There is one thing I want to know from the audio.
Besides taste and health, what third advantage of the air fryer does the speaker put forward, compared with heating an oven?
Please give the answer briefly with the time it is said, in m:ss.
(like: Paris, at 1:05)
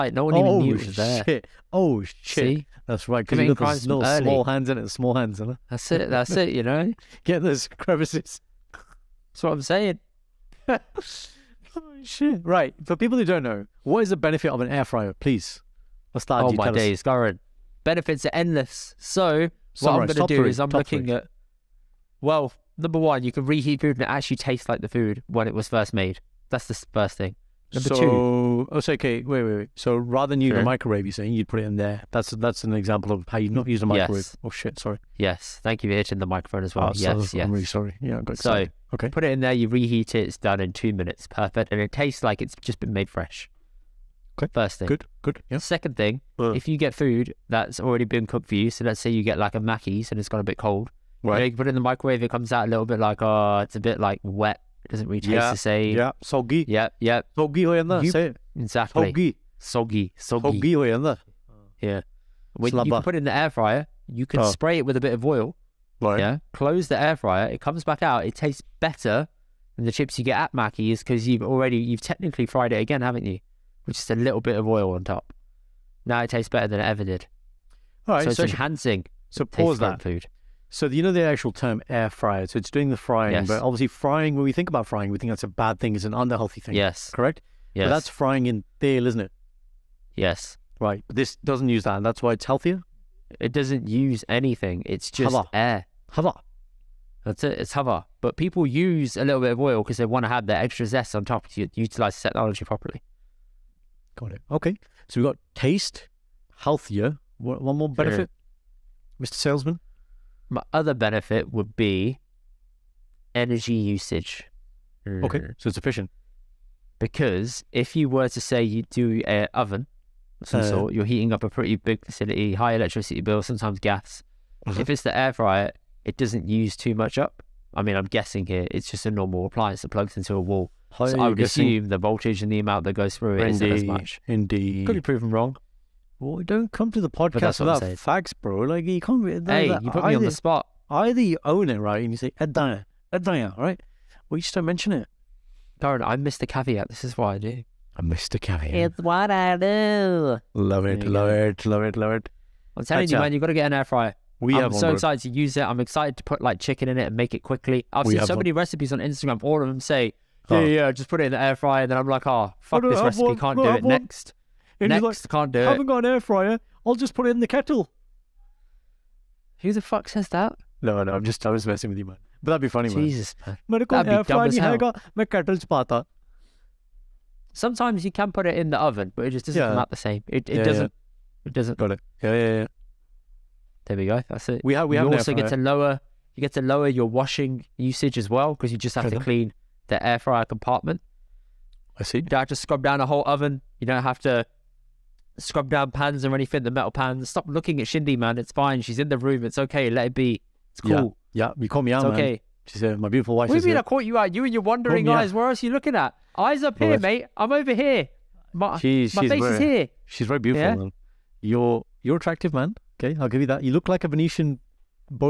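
Energy usage, at 1:53.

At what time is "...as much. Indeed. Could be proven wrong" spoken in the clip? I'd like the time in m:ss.
2:13.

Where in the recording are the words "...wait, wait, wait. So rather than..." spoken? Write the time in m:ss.
0:29.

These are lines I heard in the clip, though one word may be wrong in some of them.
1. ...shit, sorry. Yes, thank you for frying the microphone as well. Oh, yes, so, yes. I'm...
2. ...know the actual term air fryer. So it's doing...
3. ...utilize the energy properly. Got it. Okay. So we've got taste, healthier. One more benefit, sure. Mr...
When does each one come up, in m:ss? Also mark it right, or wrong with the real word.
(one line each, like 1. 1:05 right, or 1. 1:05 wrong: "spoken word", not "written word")
1. 0:34 wrong: "hitting", not "frying"
2. 1:21 right
3. 1:41 wrong: "technology", not "energy".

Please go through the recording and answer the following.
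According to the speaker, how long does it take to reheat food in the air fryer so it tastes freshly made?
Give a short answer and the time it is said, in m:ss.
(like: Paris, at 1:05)
2 minutes, at 0:40.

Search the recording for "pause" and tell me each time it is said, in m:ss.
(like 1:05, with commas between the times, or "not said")
1:19.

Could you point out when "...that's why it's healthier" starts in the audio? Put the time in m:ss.
1:32.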